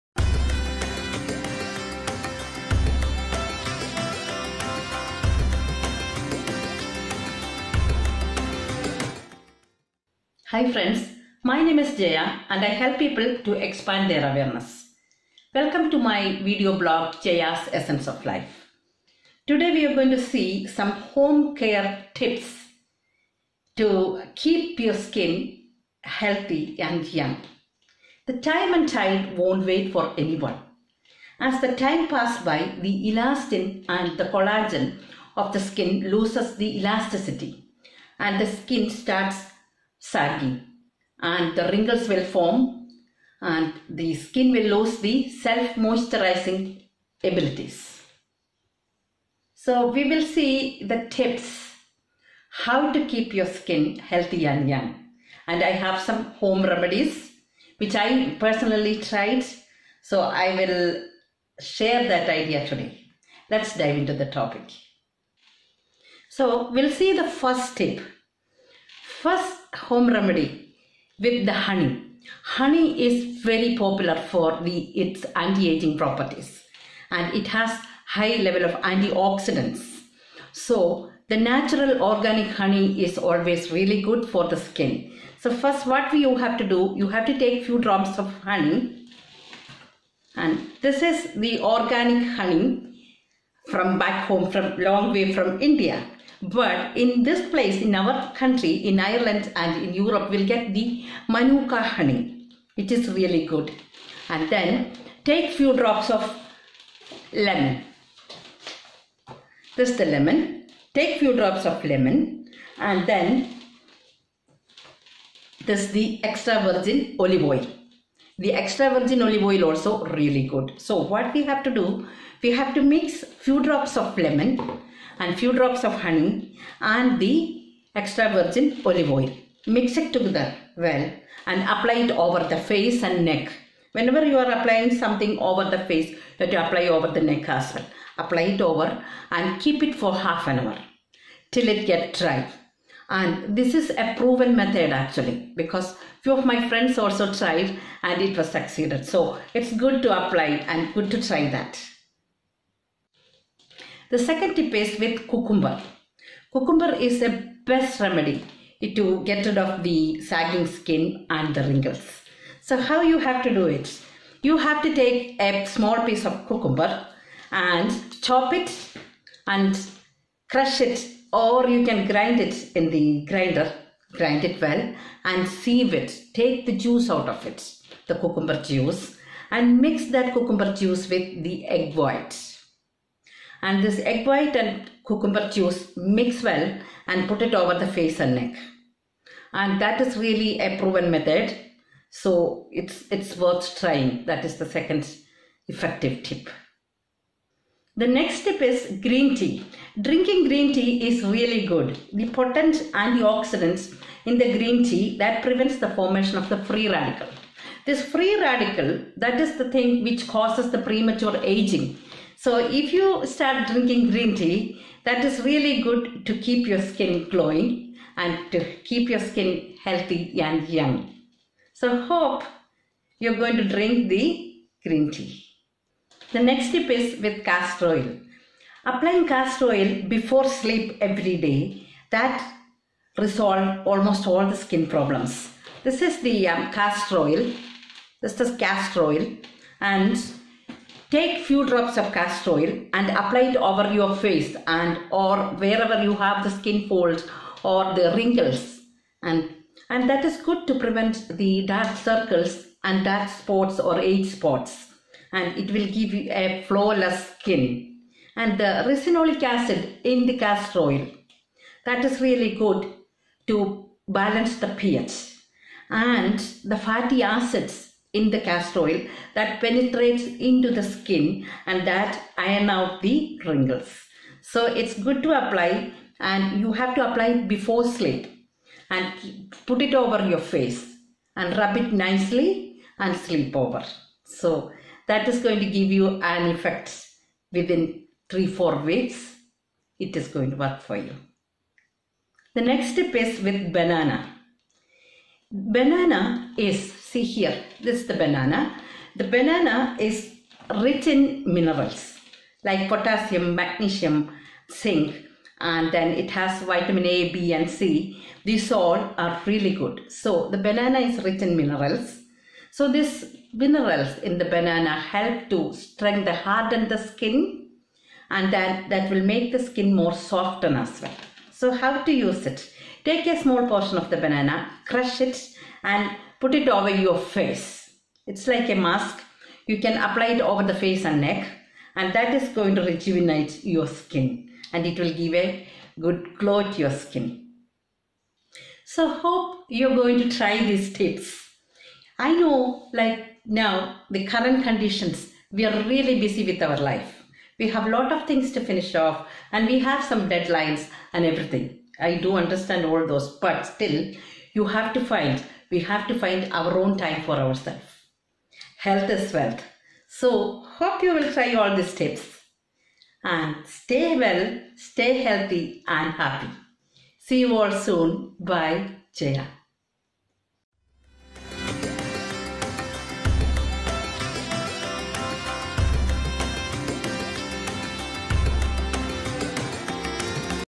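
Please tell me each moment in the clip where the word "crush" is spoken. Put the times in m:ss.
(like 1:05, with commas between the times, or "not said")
2:50, 5:24.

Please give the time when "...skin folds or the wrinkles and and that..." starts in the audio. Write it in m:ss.
4:06.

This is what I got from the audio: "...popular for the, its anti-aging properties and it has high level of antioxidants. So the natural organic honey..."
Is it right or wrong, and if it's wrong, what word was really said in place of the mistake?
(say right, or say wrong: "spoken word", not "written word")
right.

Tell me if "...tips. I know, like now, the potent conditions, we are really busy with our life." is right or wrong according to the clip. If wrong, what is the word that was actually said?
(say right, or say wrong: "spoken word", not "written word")
wrong: "current", not "potent".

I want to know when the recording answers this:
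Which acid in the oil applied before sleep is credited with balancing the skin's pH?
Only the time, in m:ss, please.
4:18.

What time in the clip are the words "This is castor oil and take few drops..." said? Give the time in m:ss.
3:58.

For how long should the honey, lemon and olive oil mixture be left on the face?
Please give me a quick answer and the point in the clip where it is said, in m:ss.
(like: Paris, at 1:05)
Half an hour, at 2:20.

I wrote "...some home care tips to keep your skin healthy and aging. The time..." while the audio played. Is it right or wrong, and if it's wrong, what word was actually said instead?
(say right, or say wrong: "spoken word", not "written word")
wrong: "young", not "aging".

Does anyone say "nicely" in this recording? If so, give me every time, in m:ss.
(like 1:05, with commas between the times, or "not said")
4:42.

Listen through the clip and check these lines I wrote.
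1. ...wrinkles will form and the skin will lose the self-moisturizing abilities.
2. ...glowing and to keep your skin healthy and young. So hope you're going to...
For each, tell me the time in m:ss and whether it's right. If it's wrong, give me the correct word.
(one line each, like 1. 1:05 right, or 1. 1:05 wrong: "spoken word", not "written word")
1. 0:41 right
2. 3:37 right.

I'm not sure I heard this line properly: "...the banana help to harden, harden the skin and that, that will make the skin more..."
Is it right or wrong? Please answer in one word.
wrong.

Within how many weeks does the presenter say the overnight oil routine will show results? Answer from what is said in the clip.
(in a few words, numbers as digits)
3 to 4 weeks.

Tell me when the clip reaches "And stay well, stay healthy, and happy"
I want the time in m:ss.
6:03.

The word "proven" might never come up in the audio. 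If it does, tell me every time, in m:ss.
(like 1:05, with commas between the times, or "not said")
2:24, 3:10.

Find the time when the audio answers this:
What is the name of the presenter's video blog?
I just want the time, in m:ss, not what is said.
0:17.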